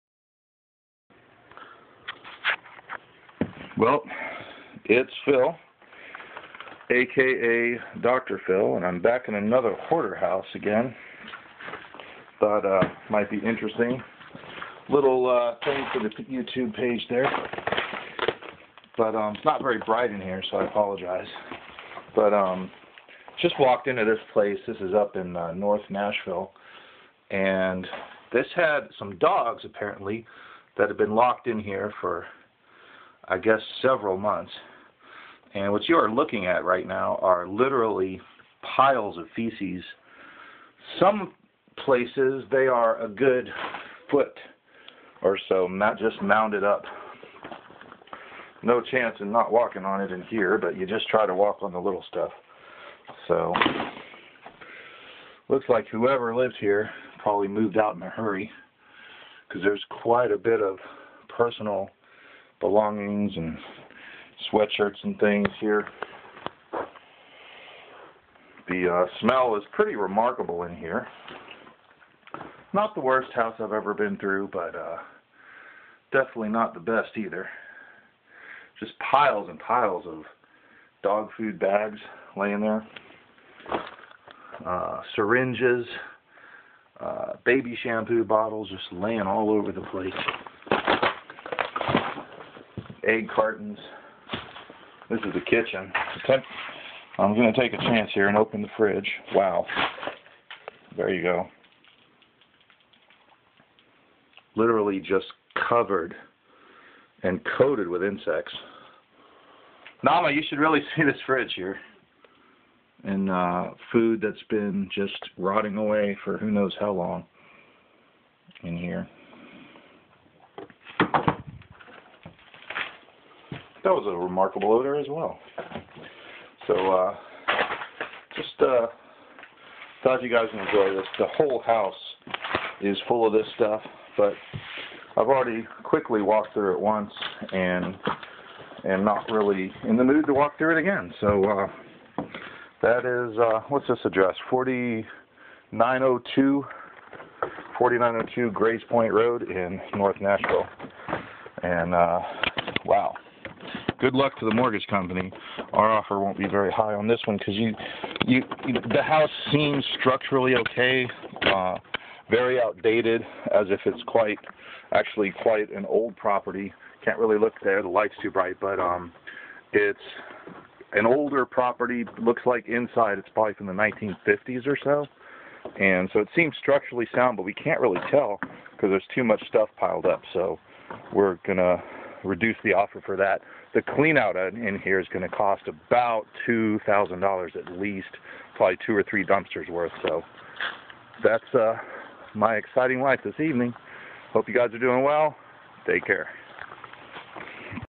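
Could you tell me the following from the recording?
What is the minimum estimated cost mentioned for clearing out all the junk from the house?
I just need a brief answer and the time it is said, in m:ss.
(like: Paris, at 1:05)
$2,000, at 3:06.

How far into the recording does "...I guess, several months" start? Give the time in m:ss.
0:33.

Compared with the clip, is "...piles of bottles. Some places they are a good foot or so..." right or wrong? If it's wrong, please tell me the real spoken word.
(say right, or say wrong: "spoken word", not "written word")
wrong: "feces", not "bottles".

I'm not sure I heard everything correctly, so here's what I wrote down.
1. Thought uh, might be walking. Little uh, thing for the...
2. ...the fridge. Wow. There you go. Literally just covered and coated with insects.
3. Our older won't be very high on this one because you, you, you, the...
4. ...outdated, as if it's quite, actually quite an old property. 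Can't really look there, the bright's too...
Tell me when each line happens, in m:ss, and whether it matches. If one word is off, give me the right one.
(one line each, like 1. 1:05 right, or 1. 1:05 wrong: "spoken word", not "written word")
1. 0:12 wrong: "interesting", not "walking"
2. 1:38 right
3. 2:35 wrong: "offer", not "older"
4. 2:42 wrong: "light", not "bright".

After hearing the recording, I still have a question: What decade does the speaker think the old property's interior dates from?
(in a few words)
1950s.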